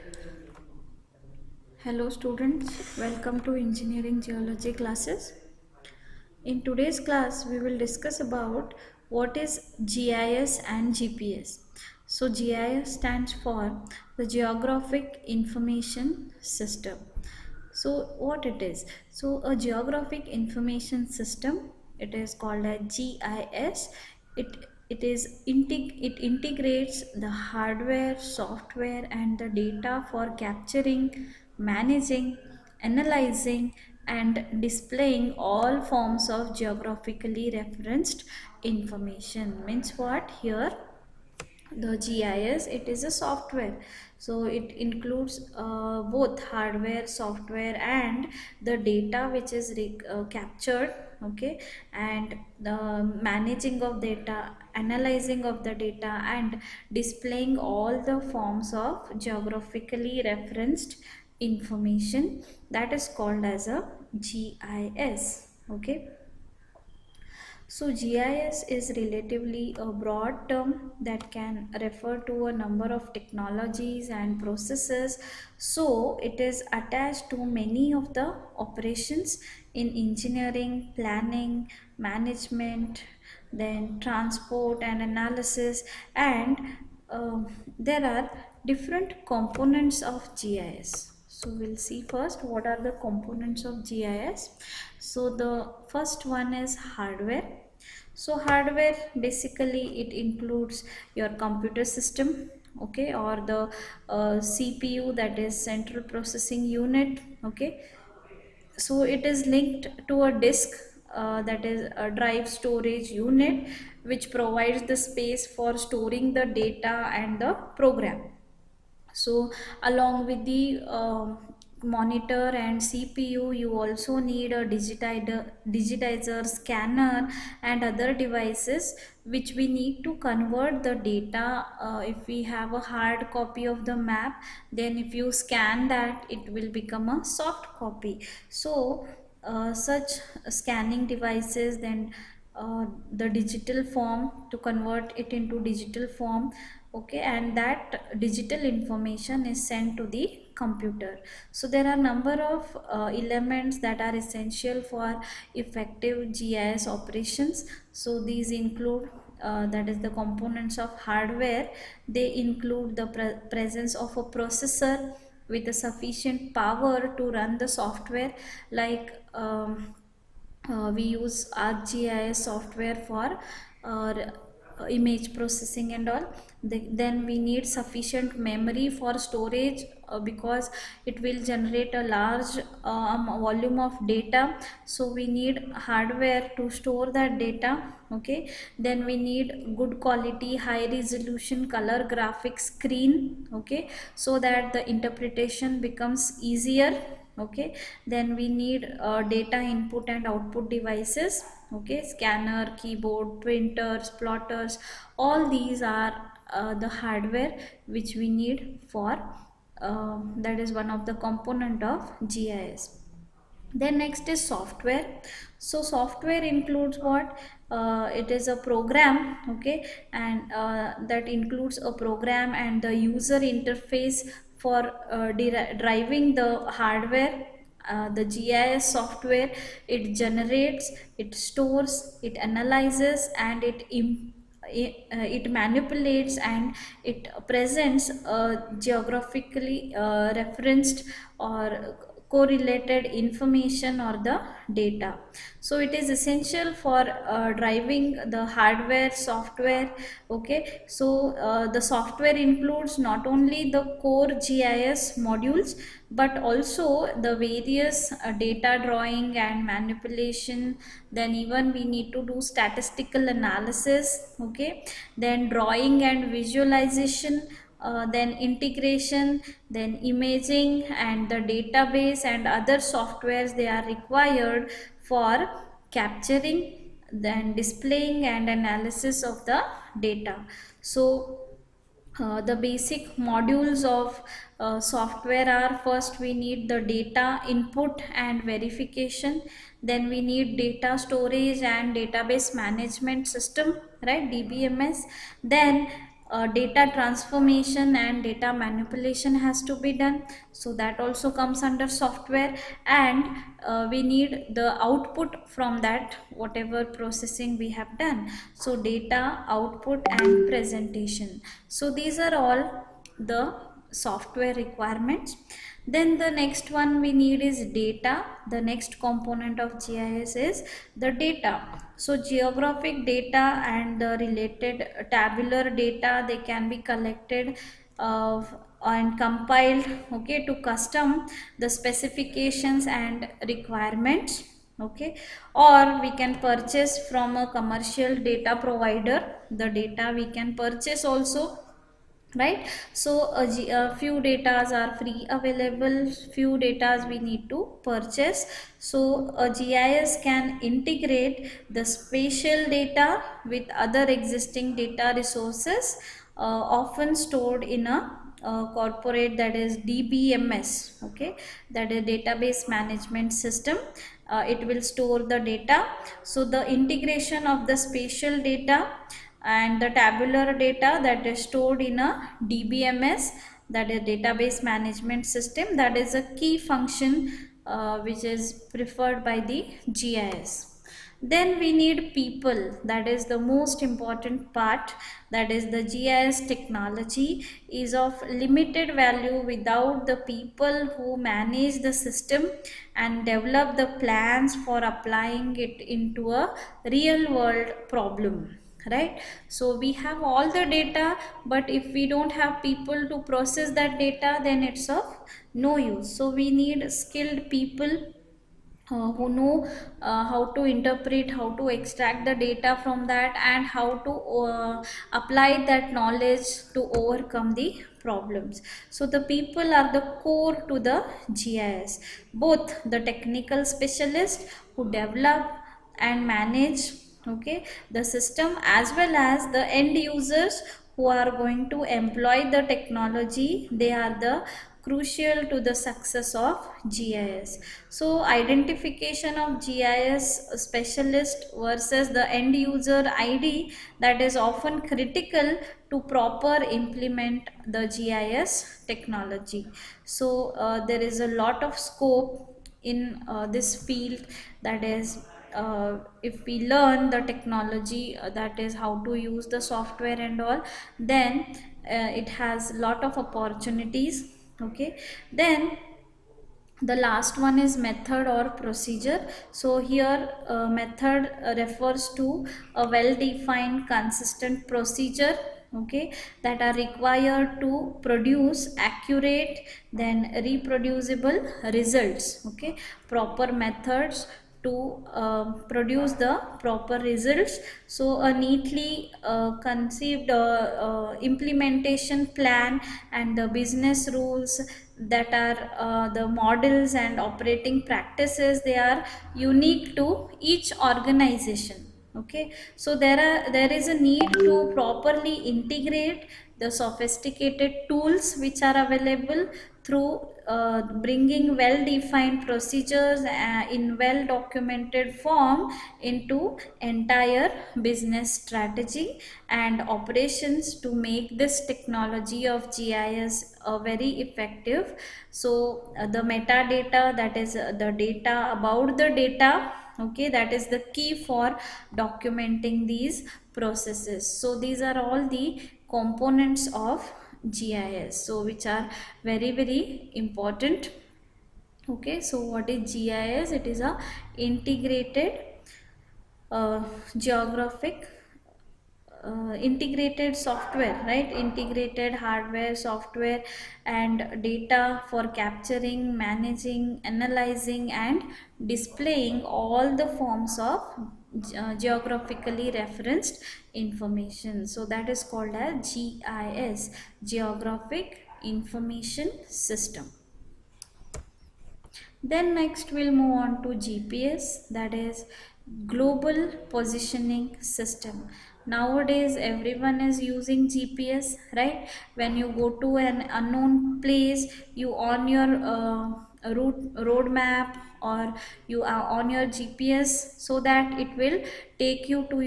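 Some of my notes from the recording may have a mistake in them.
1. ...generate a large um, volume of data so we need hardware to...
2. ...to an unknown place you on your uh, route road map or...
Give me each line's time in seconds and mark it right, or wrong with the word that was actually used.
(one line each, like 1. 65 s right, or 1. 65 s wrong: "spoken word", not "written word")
1. 181 s right
2. 582 s right.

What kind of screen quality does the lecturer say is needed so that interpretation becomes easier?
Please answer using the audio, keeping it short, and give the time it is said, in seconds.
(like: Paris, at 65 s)
high resolution color graphic screen, at 190 s.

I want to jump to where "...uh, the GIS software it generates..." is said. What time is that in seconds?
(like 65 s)
227 s.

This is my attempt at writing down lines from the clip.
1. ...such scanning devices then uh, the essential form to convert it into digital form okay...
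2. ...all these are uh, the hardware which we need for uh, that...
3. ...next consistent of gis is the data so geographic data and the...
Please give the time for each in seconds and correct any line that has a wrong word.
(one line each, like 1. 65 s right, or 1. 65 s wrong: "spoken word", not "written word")
1. 139 s wrong: "digital", not "essential"
2. 205 s right
3. 318 s wrong: "component", not "consistent".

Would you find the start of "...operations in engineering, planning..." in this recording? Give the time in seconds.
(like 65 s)
78 s.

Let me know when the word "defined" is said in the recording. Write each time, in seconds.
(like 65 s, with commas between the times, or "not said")
473 s, 511 s.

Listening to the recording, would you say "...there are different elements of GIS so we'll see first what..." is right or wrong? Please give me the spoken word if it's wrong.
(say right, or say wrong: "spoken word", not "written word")
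wrong: "components", not "elements".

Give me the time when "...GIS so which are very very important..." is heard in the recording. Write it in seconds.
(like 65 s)
537 s.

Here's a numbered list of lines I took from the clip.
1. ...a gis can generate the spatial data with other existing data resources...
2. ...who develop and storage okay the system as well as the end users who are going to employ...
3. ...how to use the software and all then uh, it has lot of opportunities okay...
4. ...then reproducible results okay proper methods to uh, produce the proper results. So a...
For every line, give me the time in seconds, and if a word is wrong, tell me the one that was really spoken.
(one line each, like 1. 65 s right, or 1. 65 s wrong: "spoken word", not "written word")
1. 349 s wrong: "integrate", not "generate"
2. 424 s wrong: "manage", not "storage"
3. 458 s right
4. 479 s right.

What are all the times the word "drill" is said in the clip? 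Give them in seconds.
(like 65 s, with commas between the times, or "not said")
not said.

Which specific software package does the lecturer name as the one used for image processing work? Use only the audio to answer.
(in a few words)
ArcGIS.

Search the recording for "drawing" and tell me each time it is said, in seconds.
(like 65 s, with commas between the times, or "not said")
258 s, 265 s.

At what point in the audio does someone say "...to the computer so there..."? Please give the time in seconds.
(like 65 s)
149 s.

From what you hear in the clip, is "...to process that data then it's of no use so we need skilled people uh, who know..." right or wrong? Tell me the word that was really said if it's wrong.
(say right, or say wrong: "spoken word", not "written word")
right.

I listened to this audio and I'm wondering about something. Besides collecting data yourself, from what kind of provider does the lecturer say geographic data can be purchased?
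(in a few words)
commercial data provider.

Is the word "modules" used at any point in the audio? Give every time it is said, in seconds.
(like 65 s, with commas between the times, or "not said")
255 s, 283 s.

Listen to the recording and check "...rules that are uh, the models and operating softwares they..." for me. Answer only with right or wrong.
wrong.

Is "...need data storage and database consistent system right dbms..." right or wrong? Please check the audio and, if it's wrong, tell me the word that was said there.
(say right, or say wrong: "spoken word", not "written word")
wrong: "management", not "consistent".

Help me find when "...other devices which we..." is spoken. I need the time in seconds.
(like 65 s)
127 s.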